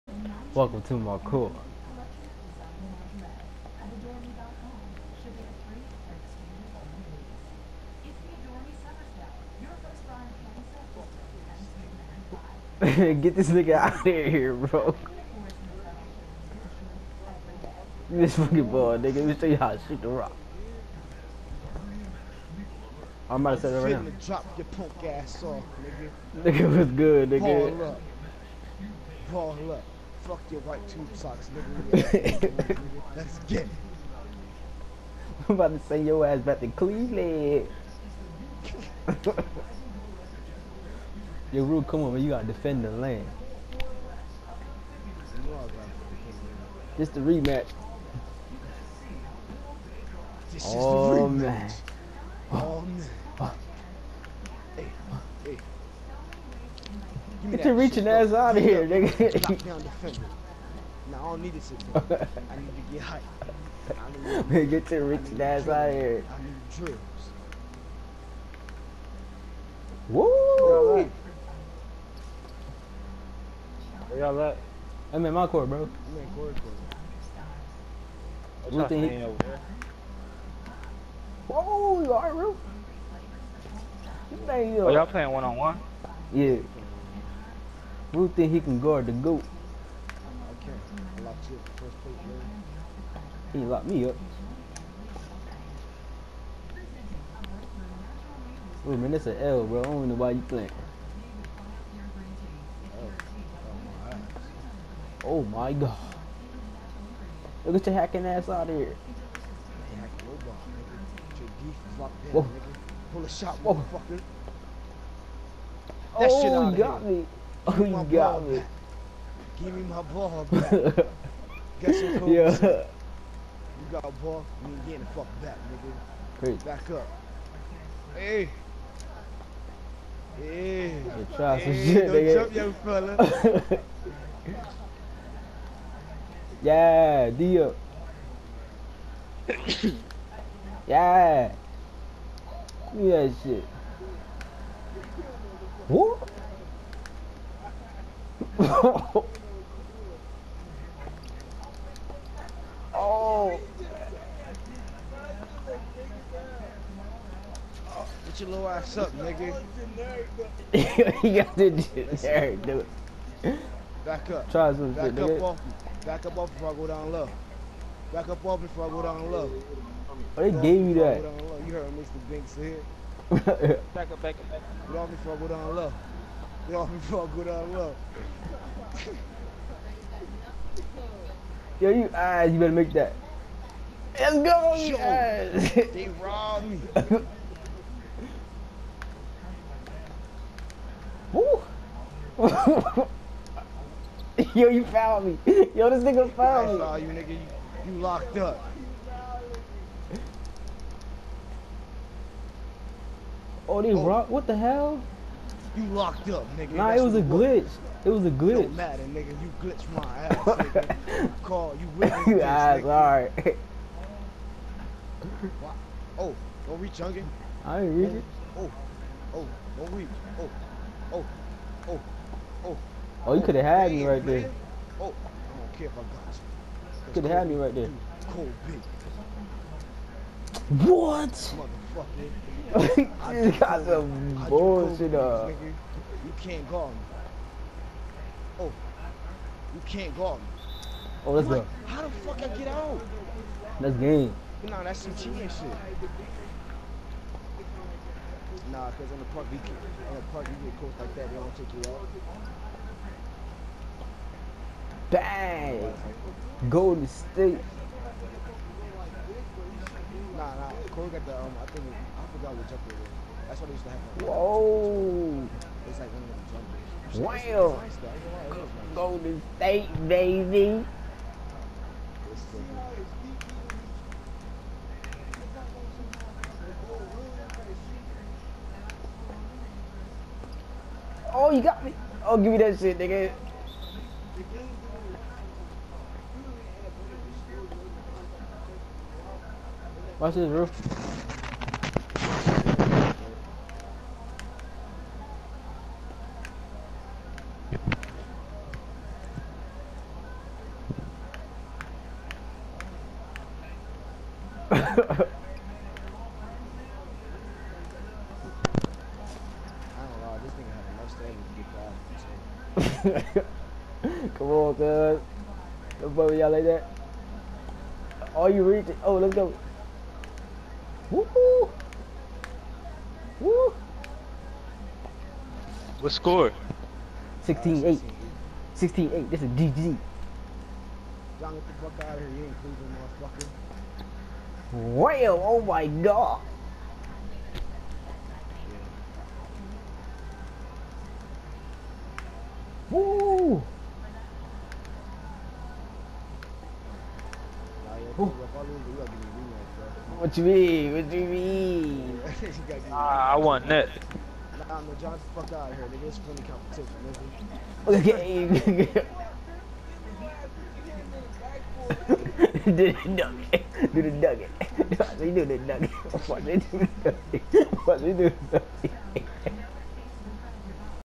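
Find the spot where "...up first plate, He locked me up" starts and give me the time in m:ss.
1:31.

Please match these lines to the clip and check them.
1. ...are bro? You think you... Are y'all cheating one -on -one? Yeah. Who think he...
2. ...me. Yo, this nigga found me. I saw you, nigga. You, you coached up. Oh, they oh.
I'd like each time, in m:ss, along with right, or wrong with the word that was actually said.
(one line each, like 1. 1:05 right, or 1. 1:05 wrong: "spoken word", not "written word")
1. 1:22 wrong: "playing", not "cheating"
2. 3:15 wrong: "locked", not "coached".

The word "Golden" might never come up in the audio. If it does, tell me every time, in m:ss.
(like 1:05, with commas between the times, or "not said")
4:16, 4:28.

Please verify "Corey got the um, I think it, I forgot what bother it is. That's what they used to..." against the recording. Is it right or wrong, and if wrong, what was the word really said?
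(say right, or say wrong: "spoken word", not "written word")
wrong: "jumper", not "bother".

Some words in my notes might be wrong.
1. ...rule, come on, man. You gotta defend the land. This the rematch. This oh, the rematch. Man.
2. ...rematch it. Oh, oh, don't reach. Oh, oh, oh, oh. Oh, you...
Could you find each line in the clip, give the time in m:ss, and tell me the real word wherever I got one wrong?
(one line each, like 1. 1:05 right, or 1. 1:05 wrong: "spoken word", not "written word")
1. 0:41 right
2. 3:37 wrong: "reach", not "rematch".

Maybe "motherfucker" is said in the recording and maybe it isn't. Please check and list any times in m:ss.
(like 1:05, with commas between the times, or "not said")
1:53, 3:52, 5:33.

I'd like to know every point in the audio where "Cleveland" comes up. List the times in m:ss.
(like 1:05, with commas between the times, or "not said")
0:36, 5:32.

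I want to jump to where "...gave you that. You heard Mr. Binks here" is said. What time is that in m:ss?
2:50.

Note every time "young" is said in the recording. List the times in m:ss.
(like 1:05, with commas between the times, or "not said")
2:12.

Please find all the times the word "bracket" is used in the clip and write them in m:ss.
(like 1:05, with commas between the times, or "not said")
not said.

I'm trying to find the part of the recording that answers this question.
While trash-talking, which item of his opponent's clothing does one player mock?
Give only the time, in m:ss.
0:30.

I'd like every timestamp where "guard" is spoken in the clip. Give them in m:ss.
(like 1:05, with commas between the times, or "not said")
1:28.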